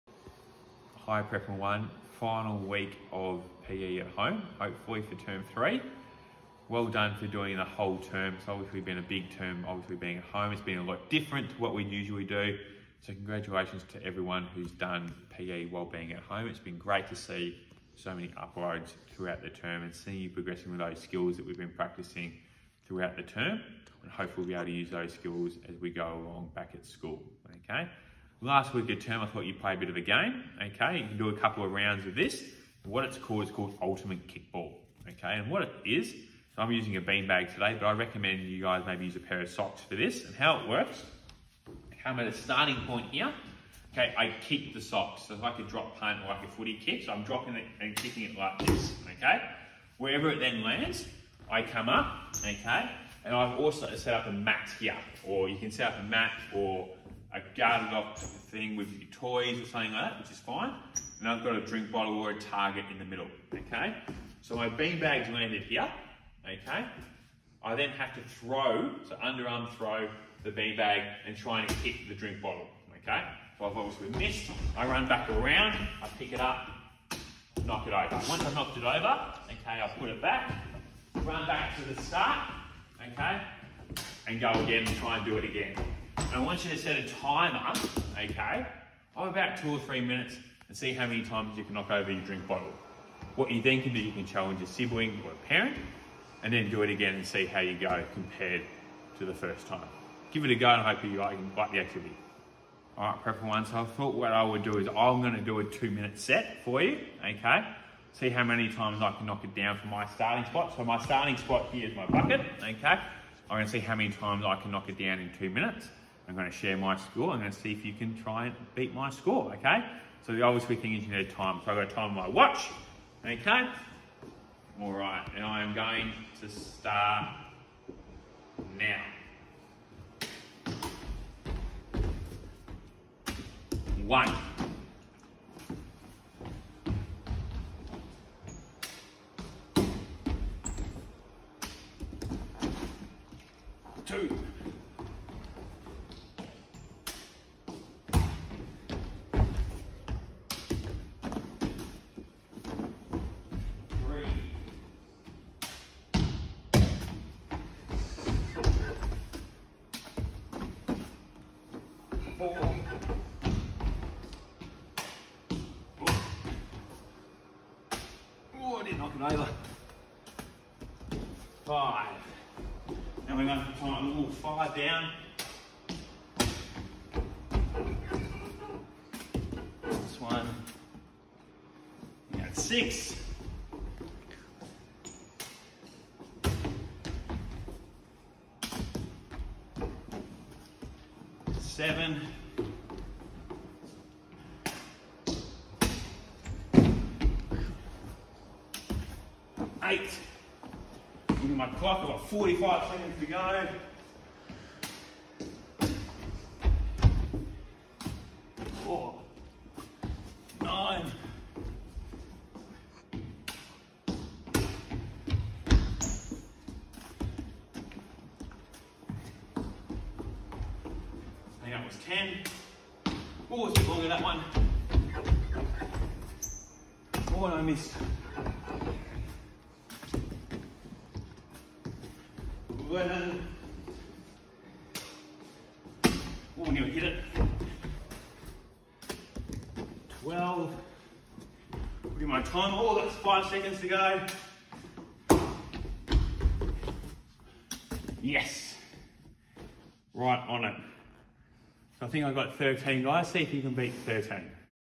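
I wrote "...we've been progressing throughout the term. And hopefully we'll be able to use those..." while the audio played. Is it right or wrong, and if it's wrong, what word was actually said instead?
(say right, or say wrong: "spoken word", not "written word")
wrong: "practicing", not "progressing".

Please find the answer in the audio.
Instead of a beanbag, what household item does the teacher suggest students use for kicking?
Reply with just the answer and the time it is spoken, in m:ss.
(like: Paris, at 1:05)
a pair of socks, at 0:39.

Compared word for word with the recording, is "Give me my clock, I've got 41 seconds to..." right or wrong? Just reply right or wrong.
wrong.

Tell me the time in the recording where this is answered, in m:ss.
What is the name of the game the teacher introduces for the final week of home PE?
0:33.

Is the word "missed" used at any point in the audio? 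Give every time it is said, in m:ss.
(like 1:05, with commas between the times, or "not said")
1:14, 3:47.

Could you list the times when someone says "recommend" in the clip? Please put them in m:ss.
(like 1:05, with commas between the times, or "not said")
0:37.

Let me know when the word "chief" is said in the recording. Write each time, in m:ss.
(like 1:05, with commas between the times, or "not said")
not said.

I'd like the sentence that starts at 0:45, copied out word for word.
So like a drop punt or like a footy kick.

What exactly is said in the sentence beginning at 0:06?
Well done for doing the whole term.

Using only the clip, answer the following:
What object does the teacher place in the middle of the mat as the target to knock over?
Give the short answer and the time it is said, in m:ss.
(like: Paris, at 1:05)
a drink bottle, at 1:01.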